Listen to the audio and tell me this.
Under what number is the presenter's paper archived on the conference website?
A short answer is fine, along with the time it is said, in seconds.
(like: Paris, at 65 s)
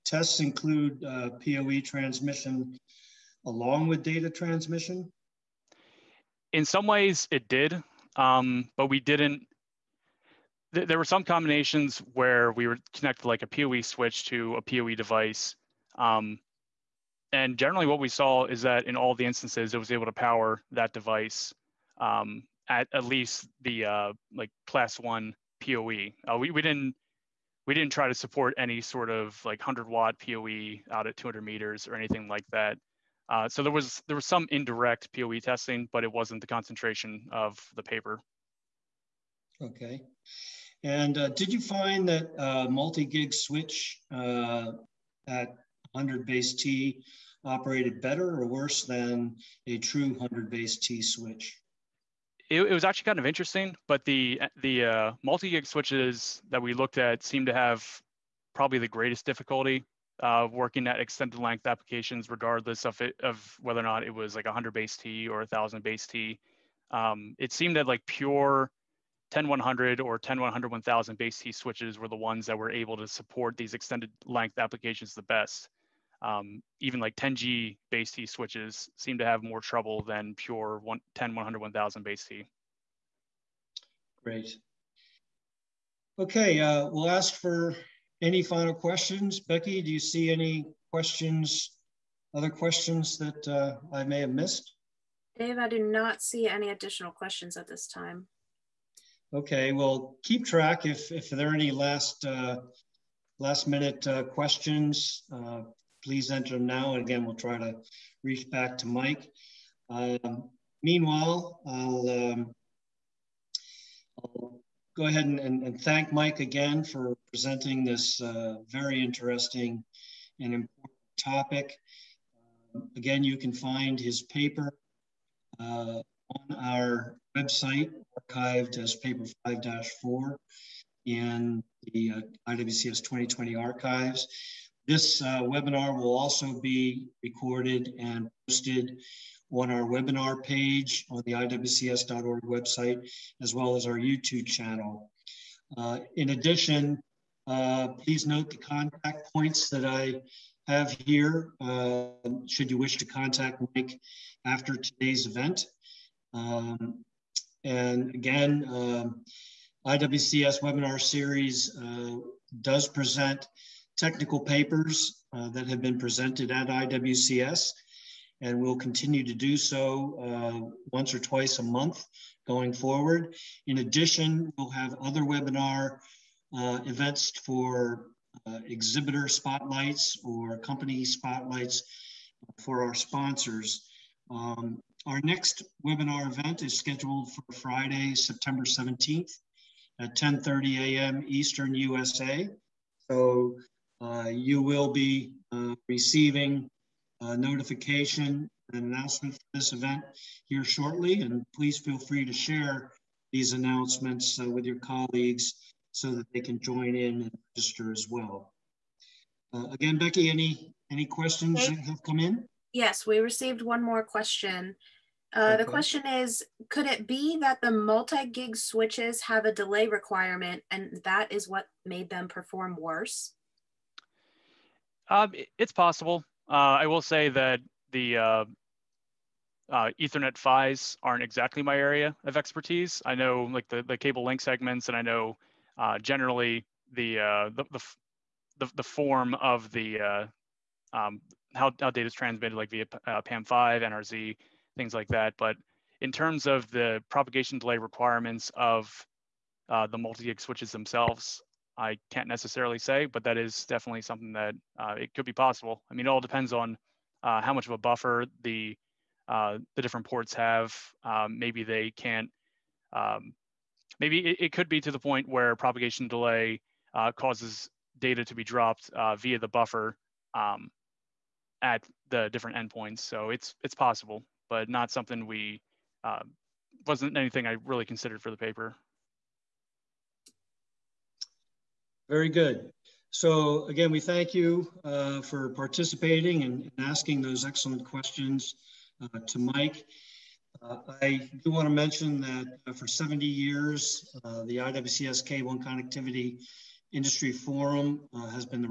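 5-4, at 128 s.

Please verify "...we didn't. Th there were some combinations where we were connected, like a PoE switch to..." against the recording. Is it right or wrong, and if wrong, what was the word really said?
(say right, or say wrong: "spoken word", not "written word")
right.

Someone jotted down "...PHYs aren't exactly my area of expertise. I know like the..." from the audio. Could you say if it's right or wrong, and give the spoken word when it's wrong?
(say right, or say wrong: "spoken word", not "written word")
right.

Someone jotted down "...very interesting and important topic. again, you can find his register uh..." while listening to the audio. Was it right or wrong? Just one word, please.
wrong.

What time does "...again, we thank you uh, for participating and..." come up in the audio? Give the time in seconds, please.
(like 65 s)
283 s.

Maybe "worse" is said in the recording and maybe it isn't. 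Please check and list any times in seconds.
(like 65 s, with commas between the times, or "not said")
48 s, 222 s.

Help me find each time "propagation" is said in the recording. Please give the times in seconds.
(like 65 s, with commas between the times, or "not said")
247 s, 265 s.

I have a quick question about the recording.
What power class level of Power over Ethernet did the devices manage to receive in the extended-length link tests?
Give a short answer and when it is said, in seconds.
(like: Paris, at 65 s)
Class 1, at 24 s.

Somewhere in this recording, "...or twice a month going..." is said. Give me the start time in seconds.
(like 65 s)
171 s.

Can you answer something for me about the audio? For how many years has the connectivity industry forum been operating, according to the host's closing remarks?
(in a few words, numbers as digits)
70.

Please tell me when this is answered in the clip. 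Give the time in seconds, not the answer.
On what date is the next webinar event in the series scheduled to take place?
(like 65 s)
187 s.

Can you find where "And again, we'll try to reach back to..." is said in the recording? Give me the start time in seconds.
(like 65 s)
106 s.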